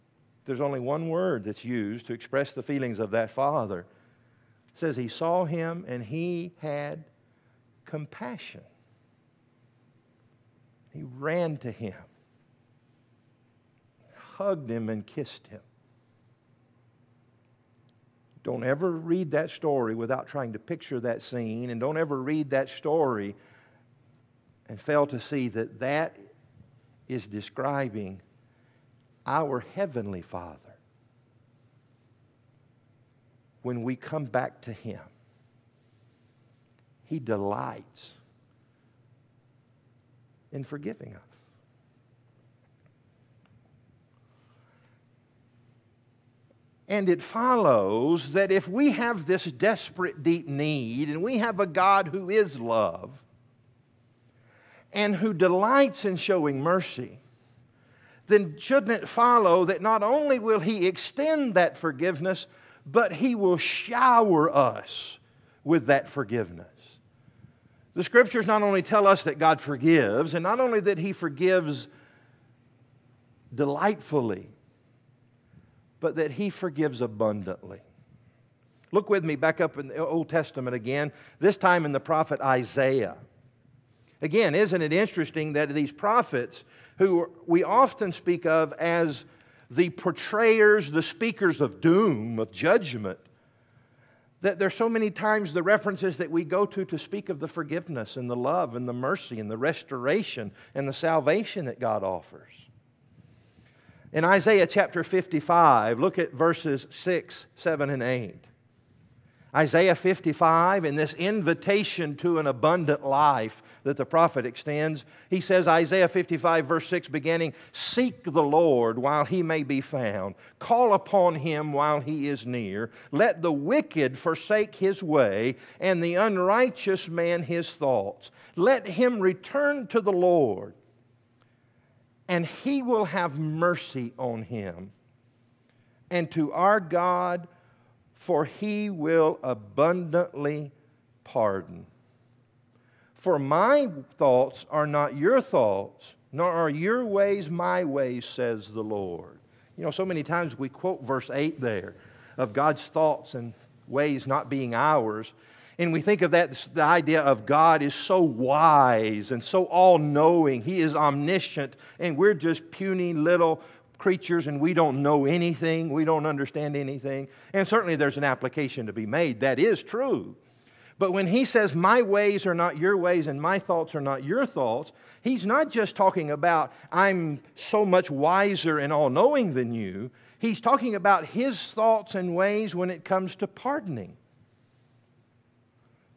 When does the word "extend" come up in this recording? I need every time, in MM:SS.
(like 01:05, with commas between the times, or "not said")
01:00, 01:54.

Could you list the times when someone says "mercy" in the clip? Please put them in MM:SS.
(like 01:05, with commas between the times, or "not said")
00:56, 01:38, 02:13.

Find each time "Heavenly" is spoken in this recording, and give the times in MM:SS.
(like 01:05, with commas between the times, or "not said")
00:29.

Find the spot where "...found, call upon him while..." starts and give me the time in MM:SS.
01:59.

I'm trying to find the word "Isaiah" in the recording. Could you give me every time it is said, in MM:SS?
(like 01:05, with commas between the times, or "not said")
01:22, 01:44, 01:49, 01:55.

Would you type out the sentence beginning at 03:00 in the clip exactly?
He's talking about his thoughts and ways when it comes to pardoning.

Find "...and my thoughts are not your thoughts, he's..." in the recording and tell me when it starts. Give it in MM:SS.
02:53.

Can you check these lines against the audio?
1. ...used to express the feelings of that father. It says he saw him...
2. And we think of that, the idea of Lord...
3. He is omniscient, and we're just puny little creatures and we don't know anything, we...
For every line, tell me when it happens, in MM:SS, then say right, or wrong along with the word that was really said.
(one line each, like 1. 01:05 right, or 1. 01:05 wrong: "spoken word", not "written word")
1. 00:01 right
2. 02:35 wrong: "God", not "Lord"
3. 02:40 right.